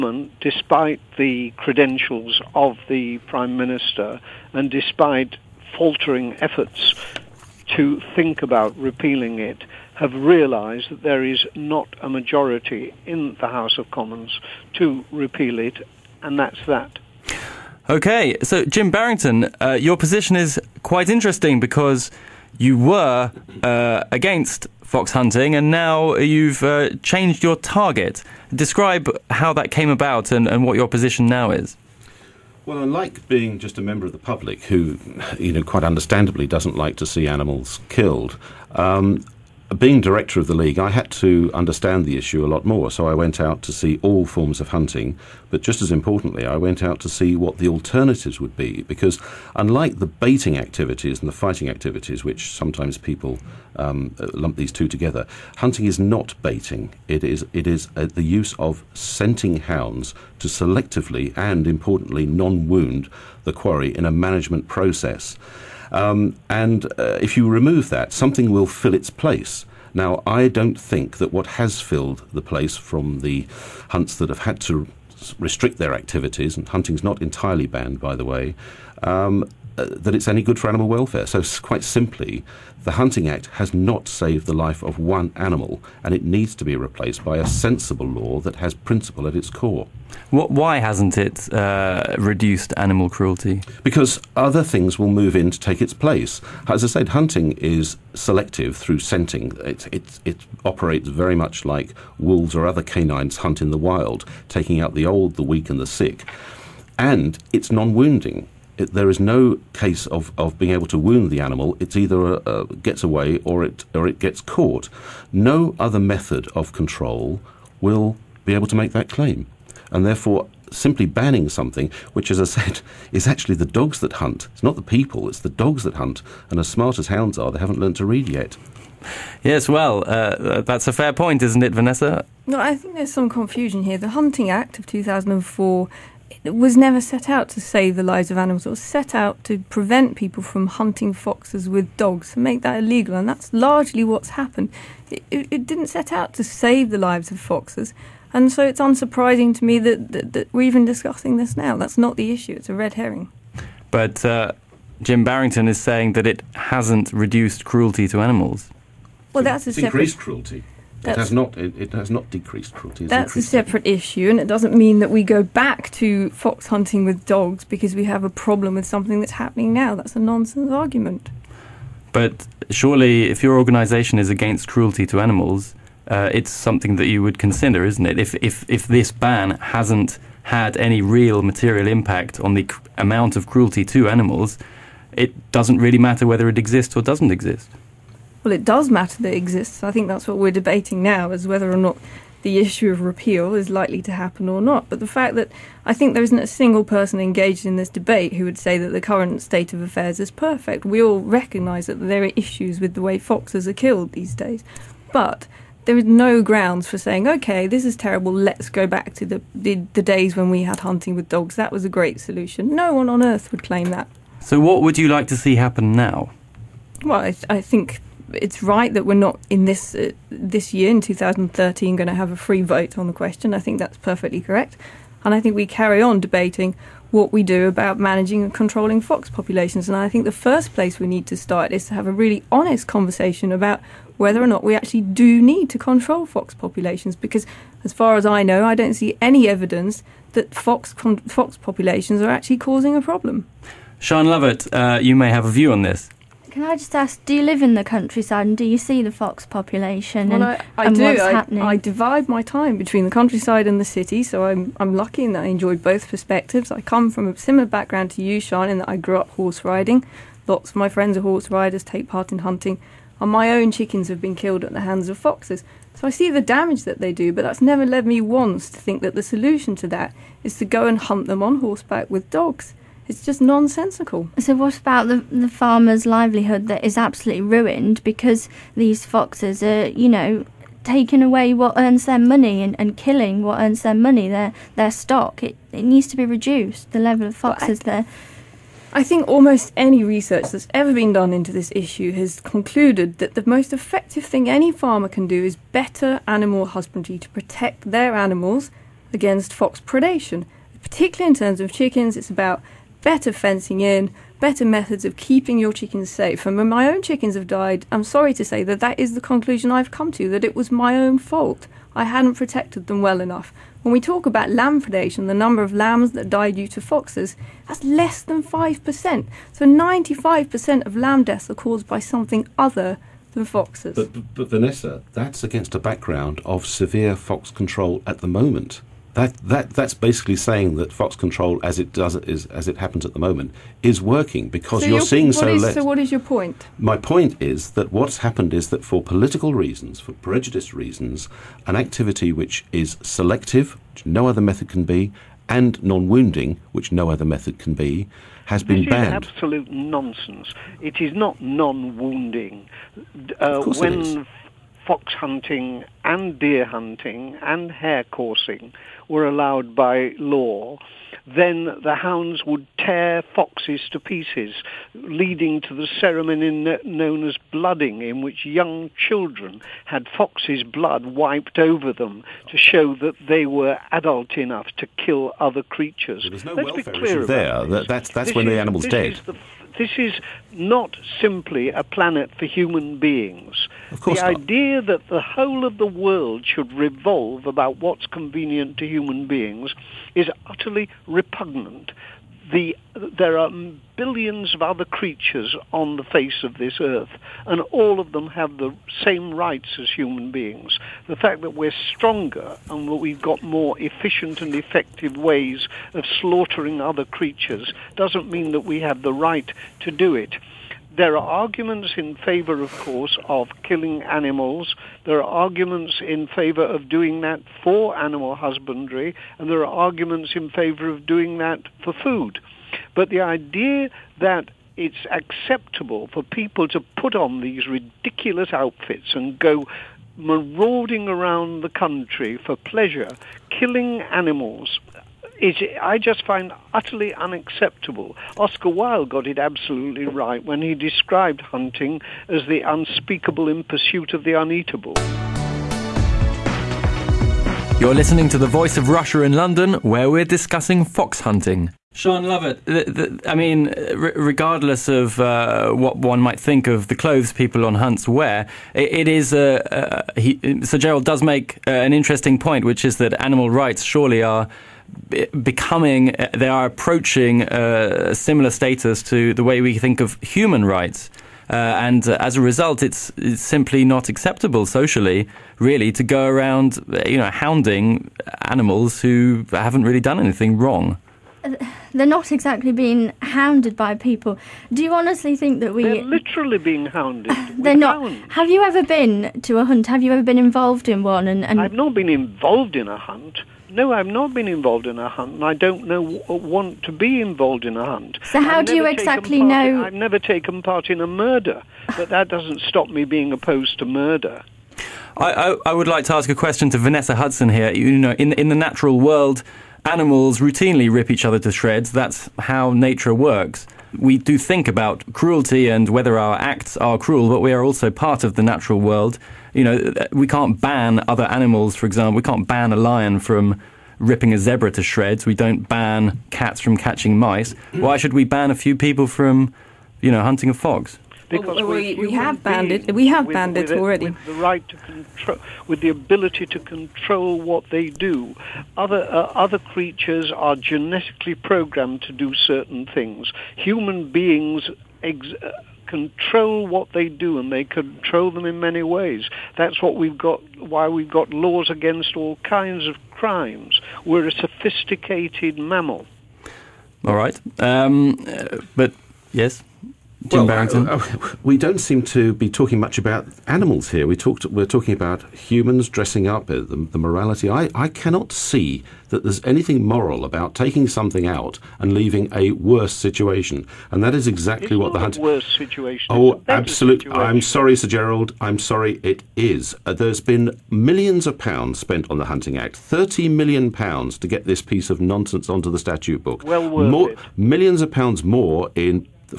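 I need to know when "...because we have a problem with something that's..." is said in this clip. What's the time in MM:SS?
02:47.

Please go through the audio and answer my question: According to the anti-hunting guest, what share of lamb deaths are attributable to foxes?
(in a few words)
less than 5%.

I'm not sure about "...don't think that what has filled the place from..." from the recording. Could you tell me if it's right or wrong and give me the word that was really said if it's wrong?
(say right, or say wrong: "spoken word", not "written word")
right.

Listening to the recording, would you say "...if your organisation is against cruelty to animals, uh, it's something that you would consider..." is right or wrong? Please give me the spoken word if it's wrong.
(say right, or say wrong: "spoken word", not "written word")
right.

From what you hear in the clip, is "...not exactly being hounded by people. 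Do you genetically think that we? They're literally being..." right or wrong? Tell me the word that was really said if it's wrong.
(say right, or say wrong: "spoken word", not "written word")
wrong: "honestly", not "genetically".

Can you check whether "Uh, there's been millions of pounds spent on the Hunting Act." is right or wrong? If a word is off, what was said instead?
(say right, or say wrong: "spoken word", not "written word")
right.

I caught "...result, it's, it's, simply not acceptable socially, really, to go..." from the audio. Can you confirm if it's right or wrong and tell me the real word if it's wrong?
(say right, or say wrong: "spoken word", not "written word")
right.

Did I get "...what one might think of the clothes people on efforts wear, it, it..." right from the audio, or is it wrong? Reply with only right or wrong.
wrong.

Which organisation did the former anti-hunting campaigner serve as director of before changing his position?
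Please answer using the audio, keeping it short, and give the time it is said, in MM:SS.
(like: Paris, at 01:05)
the League, at 00:40.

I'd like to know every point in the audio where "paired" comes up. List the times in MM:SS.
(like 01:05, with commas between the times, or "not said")
not said.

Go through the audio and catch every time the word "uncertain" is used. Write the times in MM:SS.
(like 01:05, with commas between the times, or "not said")
not said.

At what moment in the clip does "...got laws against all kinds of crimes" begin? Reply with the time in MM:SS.
09:11.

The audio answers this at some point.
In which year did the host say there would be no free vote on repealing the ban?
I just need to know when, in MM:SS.
03:40.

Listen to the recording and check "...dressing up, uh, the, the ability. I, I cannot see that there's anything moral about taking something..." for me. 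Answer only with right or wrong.
wrong.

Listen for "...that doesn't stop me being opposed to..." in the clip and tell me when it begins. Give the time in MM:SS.
08:22.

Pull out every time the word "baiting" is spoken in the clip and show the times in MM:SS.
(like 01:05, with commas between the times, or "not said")
00:50, 00:56.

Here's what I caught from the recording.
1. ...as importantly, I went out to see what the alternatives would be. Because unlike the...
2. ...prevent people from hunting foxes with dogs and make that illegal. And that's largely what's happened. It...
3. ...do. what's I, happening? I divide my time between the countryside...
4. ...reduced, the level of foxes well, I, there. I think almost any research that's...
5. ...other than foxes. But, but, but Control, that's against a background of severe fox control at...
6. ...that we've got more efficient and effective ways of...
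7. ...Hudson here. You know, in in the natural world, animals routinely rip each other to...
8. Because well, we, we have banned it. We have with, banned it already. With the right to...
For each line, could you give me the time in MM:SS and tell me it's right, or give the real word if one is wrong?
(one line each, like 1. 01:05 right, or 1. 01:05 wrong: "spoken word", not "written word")
1. 00:45 right
2. 02:19 right
3. 04:10 right
4. 04:46 right
5. 05:22 wrong: "Vanessa", not "Control"
6. 06:42 right
7. 08:27 right
8. 08:51 right.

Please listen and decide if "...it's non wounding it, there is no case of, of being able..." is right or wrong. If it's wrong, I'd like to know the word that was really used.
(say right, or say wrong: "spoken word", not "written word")
right.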